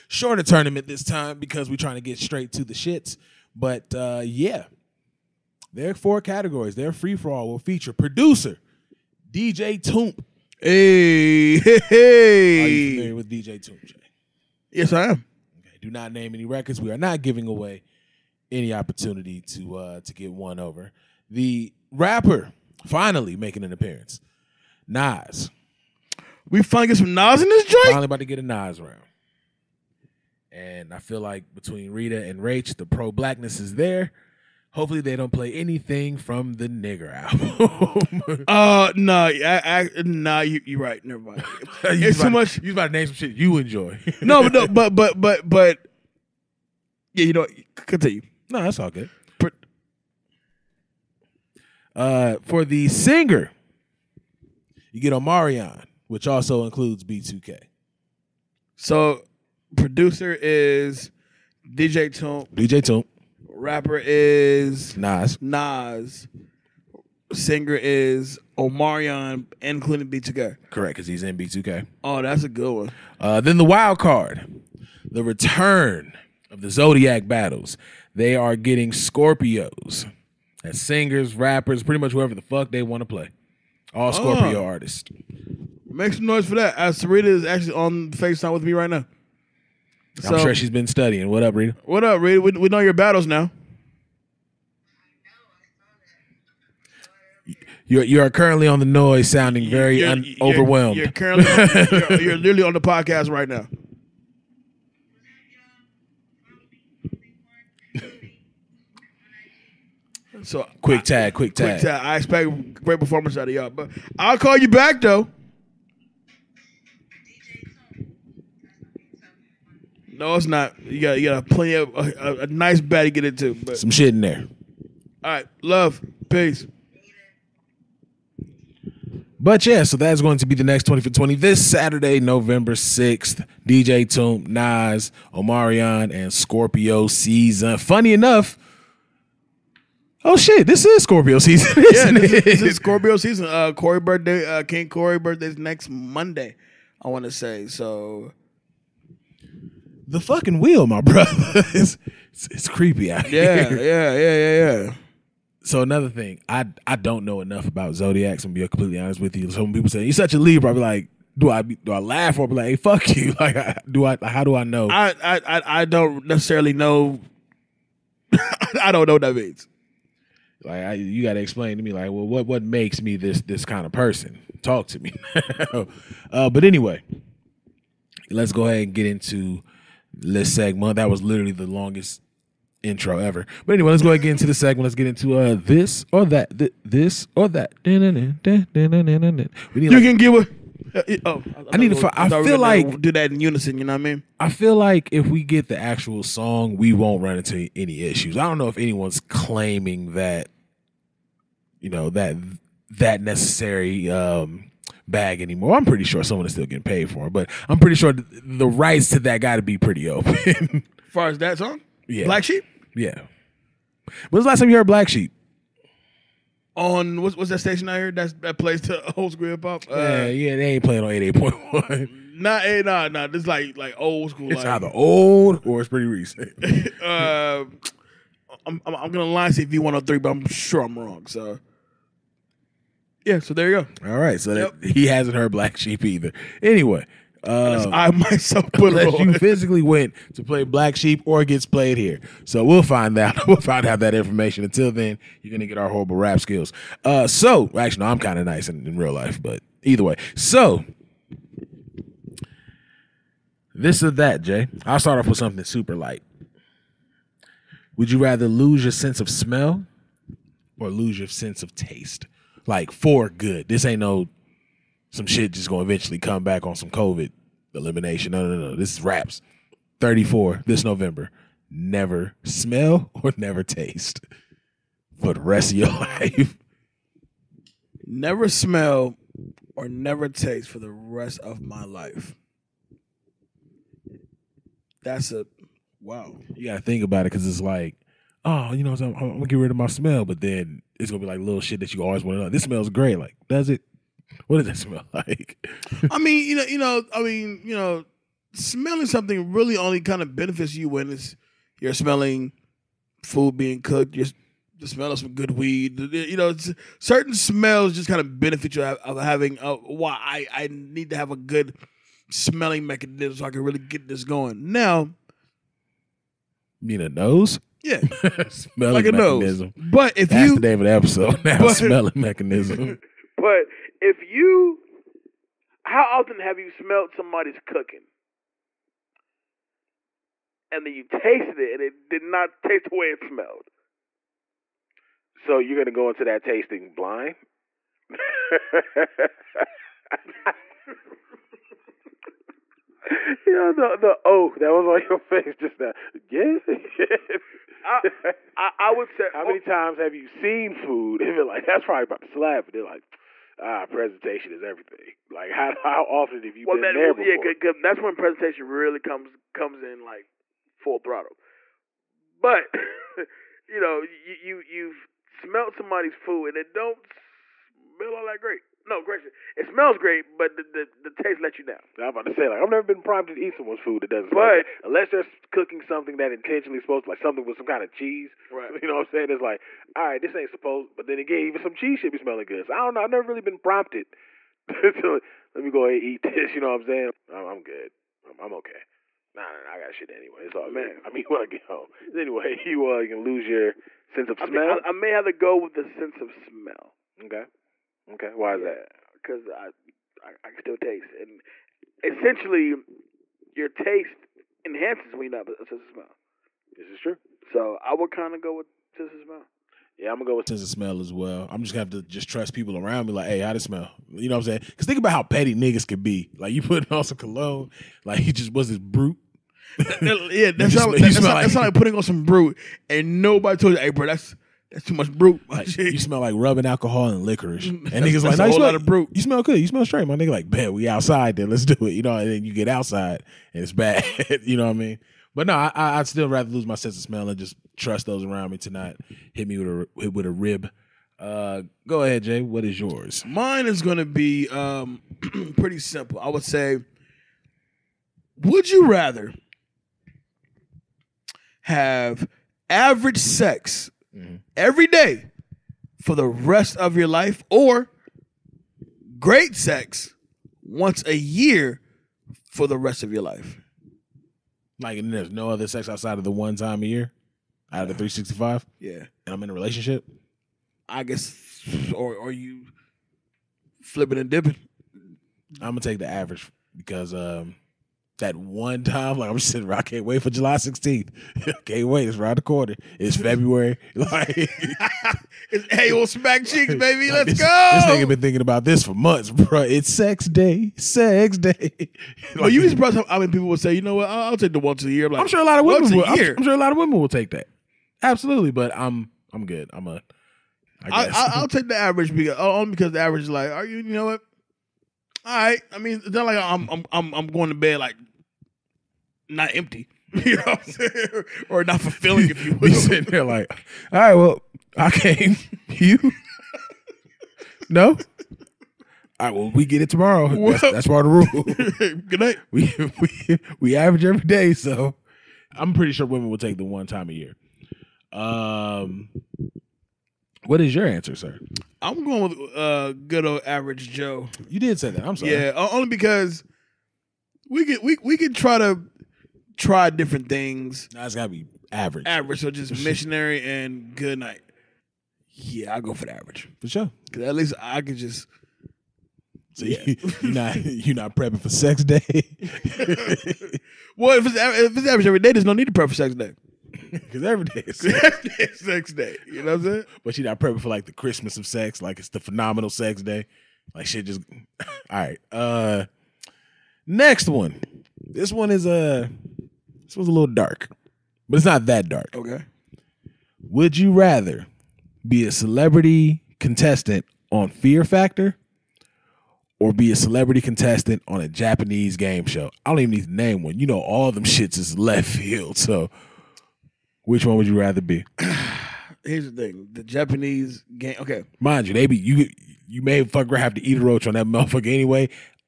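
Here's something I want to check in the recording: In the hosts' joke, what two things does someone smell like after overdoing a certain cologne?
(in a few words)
Rubbing alcohol and licorice.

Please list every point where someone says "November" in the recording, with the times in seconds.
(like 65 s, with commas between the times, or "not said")
132 s, 270 s.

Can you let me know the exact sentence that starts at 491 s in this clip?
Oh, like, well, you just brought how I many people would say, you know what?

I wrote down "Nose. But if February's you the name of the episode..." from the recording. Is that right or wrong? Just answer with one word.
wrong.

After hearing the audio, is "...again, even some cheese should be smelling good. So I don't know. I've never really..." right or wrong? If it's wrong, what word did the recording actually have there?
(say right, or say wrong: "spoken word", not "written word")
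right.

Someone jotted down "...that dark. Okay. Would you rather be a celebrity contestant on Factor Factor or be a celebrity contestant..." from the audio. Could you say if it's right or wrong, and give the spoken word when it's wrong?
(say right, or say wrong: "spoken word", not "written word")
wrong: "Fear", not "Factor".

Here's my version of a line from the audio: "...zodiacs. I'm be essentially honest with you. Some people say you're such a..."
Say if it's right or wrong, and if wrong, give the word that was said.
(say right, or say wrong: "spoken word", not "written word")
wrong: "completely", not "essentially".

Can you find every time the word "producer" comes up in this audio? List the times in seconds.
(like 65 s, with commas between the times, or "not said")
7 s, 59 s.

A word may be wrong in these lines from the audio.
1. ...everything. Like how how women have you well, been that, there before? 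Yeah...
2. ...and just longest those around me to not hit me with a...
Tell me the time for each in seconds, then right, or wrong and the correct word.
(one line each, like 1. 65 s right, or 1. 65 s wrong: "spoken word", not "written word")
1. 354 s wrong: "often", not "women"
2. 437 s wrong: "trust", not "longest".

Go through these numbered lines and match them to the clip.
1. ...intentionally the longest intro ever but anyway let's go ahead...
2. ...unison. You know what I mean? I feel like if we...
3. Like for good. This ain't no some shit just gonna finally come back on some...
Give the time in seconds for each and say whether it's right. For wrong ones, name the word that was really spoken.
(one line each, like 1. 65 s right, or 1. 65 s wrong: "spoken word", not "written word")
1. 181 s wrong: "literally", not "intentionally"
2. 193 s right
3. 262 s wrong: "eventually", not "finally".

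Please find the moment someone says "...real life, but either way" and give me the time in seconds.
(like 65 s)
248 s.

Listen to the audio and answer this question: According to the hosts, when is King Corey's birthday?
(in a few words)
Next Monday.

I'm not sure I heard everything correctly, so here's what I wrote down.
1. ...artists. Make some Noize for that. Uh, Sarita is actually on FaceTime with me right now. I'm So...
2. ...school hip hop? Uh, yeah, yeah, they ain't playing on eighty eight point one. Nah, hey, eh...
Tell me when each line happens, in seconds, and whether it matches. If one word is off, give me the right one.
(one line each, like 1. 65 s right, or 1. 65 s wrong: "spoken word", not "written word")
1. 84 s right
2. 219 s right.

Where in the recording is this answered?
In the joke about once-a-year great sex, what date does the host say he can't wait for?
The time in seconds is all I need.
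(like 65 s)
480 s.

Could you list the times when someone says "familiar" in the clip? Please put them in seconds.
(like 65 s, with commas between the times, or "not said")
12 s.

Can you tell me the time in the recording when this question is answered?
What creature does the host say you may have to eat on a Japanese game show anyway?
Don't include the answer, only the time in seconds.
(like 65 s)
593 s.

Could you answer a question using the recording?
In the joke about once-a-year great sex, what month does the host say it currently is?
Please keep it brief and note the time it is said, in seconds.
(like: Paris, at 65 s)
February, at 483 s.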